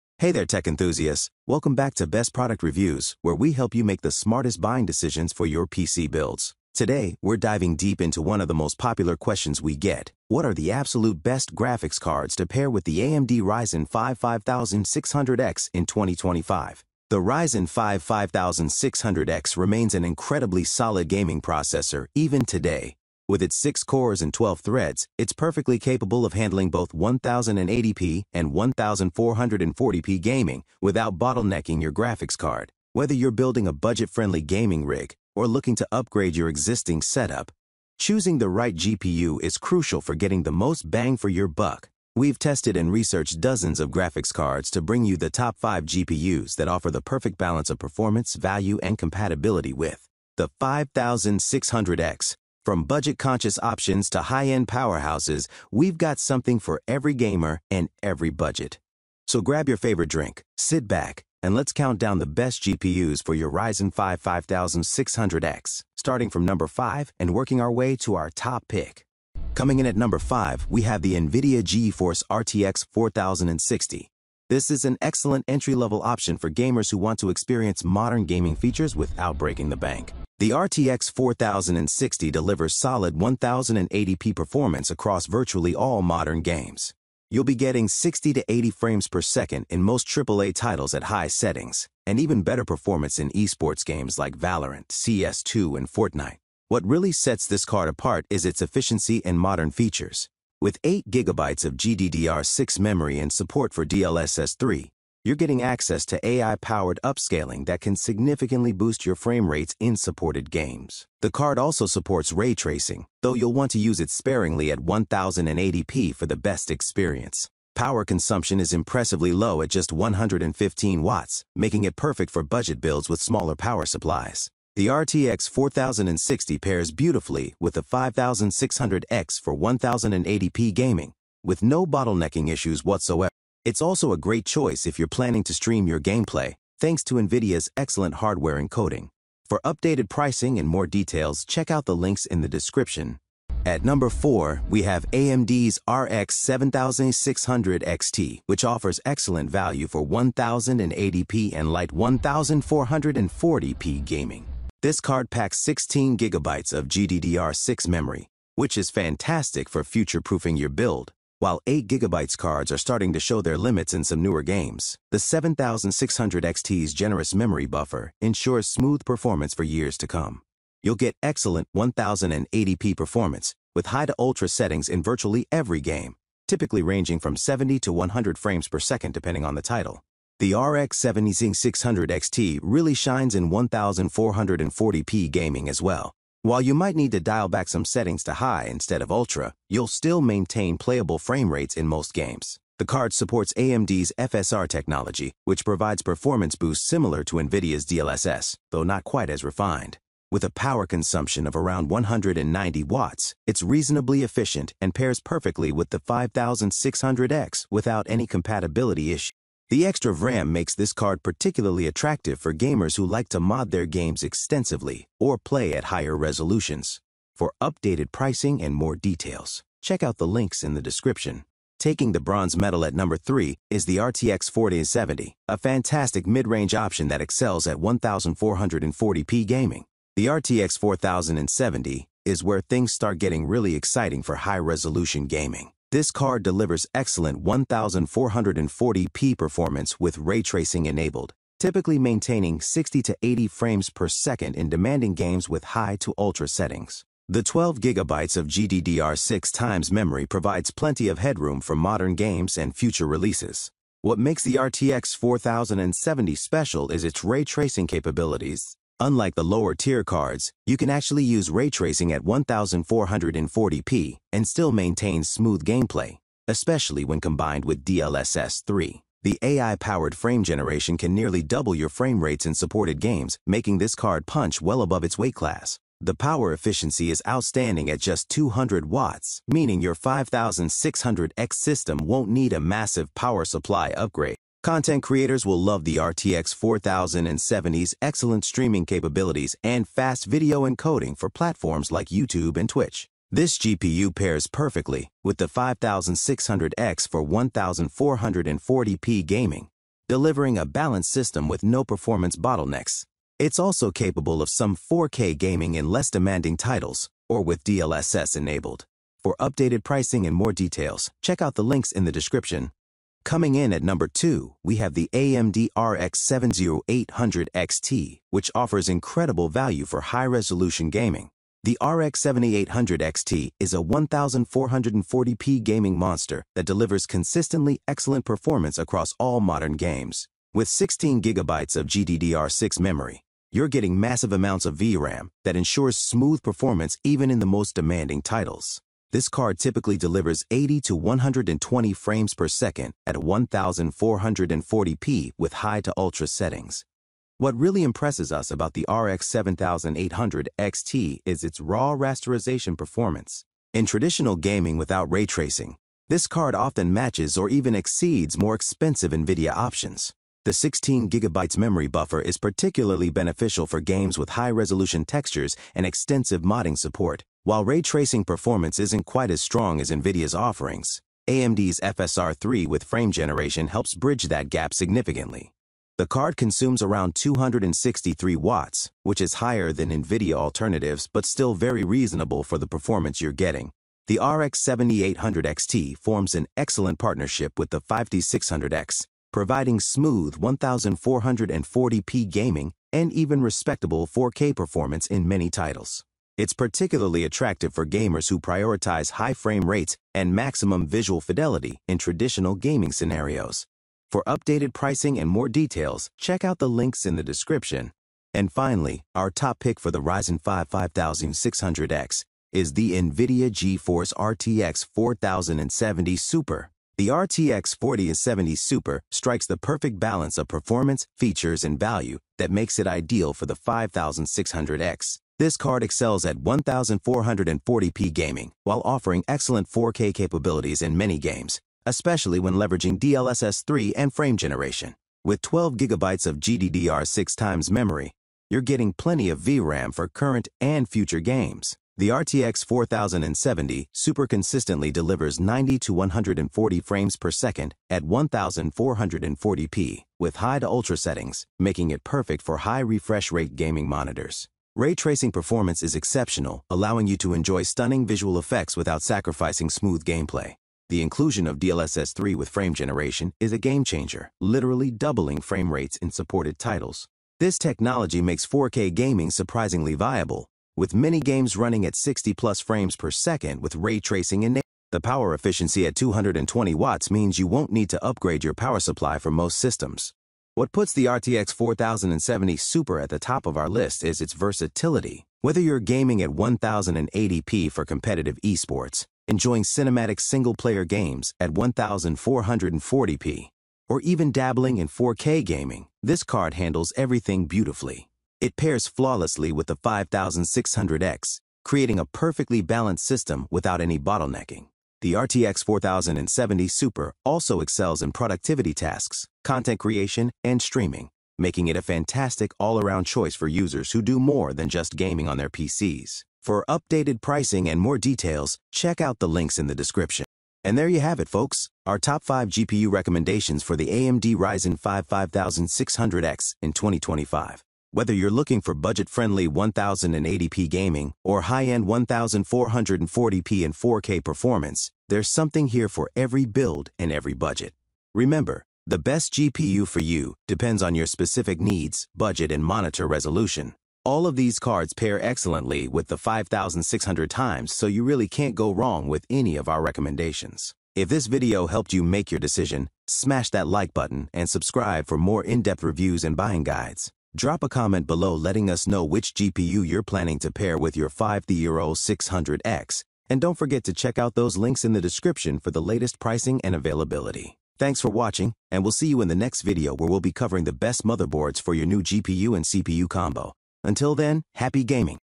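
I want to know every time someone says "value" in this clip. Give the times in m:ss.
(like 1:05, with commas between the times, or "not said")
0:48, 2:29, 5:19, 7:01.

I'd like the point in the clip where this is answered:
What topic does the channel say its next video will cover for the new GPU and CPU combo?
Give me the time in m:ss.
9:31.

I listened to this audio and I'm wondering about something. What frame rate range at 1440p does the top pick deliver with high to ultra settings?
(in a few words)
90 to 140.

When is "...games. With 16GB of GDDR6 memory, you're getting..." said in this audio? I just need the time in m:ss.
5:29.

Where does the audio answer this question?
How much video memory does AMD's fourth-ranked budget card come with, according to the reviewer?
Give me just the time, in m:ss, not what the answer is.
2:35.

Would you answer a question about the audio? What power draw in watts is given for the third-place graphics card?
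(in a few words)
200.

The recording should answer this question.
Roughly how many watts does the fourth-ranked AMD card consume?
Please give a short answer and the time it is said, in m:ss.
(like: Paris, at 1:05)
190, at 3:21.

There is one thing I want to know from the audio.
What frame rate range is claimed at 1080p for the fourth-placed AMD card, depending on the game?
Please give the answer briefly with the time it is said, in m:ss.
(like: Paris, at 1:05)
70 to 100, at 2:57.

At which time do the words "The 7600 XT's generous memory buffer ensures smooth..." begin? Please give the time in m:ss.
2:45.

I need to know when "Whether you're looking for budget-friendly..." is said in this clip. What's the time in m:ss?
8:47.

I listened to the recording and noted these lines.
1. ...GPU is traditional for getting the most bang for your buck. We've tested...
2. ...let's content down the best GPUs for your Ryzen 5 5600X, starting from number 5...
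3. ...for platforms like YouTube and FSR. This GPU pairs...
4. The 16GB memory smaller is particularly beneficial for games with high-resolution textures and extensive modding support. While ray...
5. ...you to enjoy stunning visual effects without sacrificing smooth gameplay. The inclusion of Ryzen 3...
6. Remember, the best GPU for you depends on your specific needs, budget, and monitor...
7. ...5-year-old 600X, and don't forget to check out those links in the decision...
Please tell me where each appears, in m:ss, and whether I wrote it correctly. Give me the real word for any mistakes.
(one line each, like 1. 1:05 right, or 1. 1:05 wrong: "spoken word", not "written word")
1. 0:38 wrong: "crucial", not "traditional"
2. 1:01 wrong: "count", not "content"
3. 4:51 wrong: "Twitch", not "FSR"
4. 6:00 wrong: "buffer", not "smaller"
5. 7:37 wrong: "DLSS", not "Ryzen"
6. 8:58 right
7. 9:21 wrong: "description", not "decision".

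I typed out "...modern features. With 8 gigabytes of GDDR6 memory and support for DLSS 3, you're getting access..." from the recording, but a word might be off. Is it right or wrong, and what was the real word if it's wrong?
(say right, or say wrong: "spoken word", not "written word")
right.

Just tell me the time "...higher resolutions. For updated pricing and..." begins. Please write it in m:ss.
3:35.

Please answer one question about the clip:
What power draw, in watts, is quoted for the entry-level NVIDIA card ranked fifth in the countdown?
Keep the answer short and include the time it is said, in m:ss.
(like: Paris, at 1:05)
115, at 1:59.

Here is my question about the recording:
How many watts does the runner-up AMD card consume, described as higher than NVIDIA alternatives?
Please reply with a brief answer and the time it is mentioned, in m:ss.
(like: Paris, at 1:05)
263, at 6:17.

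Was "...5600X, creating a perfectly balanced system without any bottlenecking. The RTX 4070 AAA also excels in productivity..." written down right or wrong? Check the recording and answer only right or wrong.
wrong.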